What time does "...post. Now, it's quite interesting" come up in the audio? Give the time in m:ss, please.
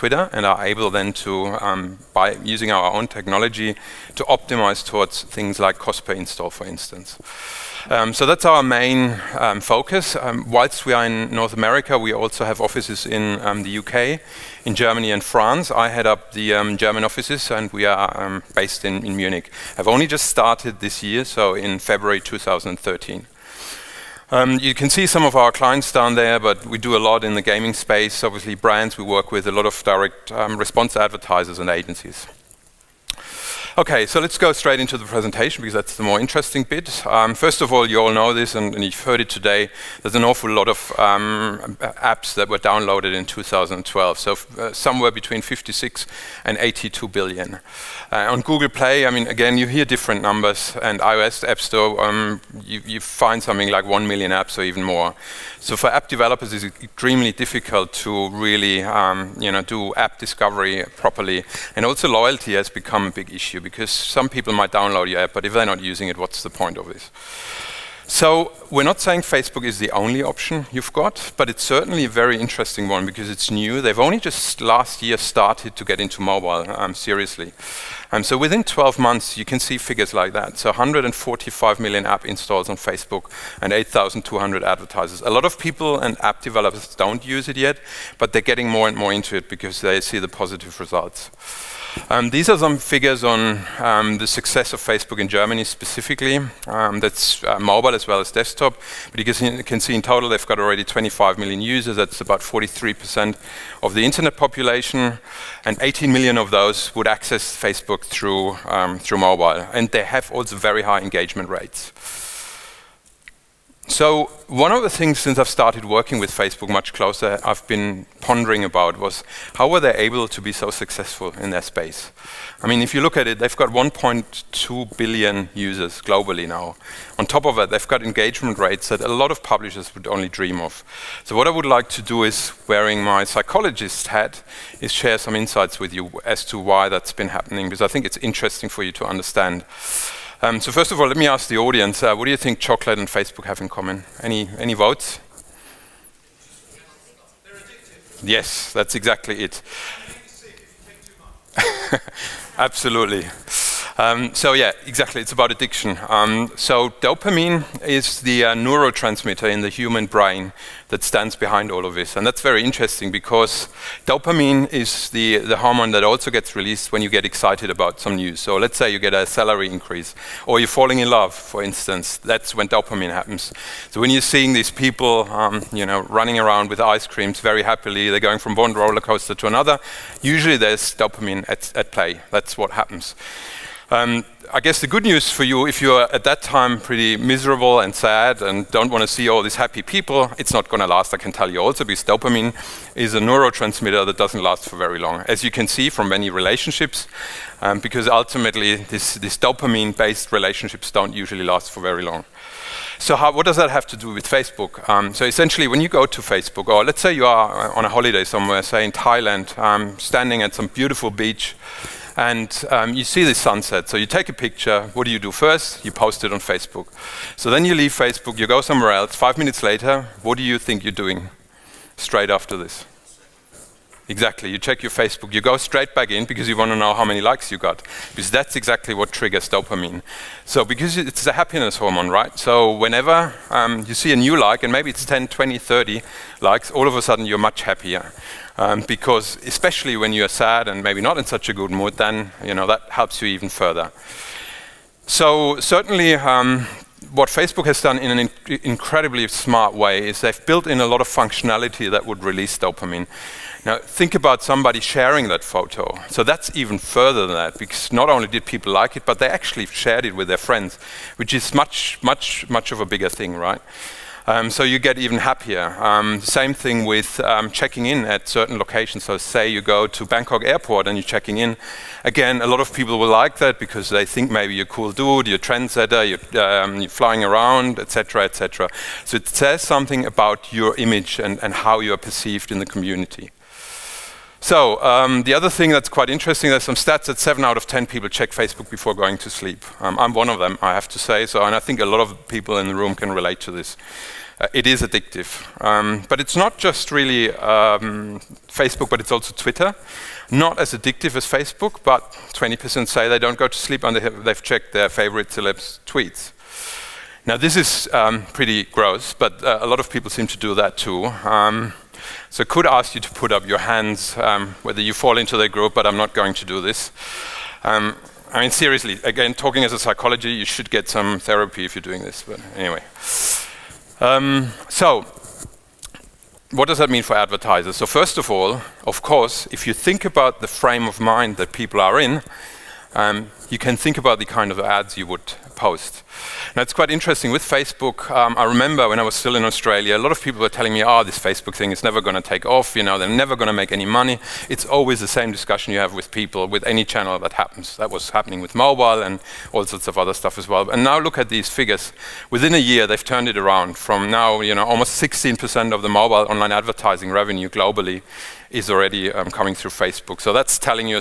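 5:35.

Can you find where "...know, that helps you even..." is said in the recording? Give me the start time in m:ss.
4:02.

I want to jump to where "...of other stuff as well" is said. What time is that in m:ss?
5:49.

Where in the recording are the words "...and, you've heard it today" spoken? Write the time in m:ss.
0:38.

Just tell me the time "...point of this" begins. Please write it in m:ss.
1:06.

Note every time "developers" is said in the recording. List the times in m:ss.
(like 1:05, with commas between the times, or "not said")
0:56, 1:26.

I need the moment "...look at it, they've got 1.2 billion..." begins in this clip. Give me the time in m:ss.
2:03.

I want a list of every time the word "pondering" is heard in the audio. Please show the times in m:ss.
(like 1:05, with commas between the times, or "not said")
1:58.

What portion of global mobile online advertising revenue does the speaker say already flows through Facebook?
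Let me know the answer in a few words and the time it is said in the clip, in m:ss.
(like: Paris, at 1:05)
almost 16%, at 5:54.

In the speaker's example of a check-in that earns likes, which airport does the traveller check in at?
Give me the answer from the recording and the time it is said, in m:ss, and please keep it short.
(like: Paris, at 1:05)
Bangkok airport, at 4:30.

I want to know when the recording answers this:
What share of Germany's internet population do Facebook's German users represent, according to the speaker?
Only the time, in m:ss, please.
1:42.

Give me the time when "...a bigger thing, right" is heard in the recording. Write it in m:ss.
4:22.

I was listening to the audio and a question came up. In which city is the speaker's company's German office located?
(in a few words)
Munich.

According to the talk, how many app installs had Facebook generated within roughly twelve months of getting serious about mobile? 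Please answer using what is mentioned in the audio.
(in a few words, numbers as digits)
145 million.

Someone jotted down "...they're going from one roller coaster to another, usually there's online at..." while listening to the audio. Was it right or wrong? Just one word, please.
wrong.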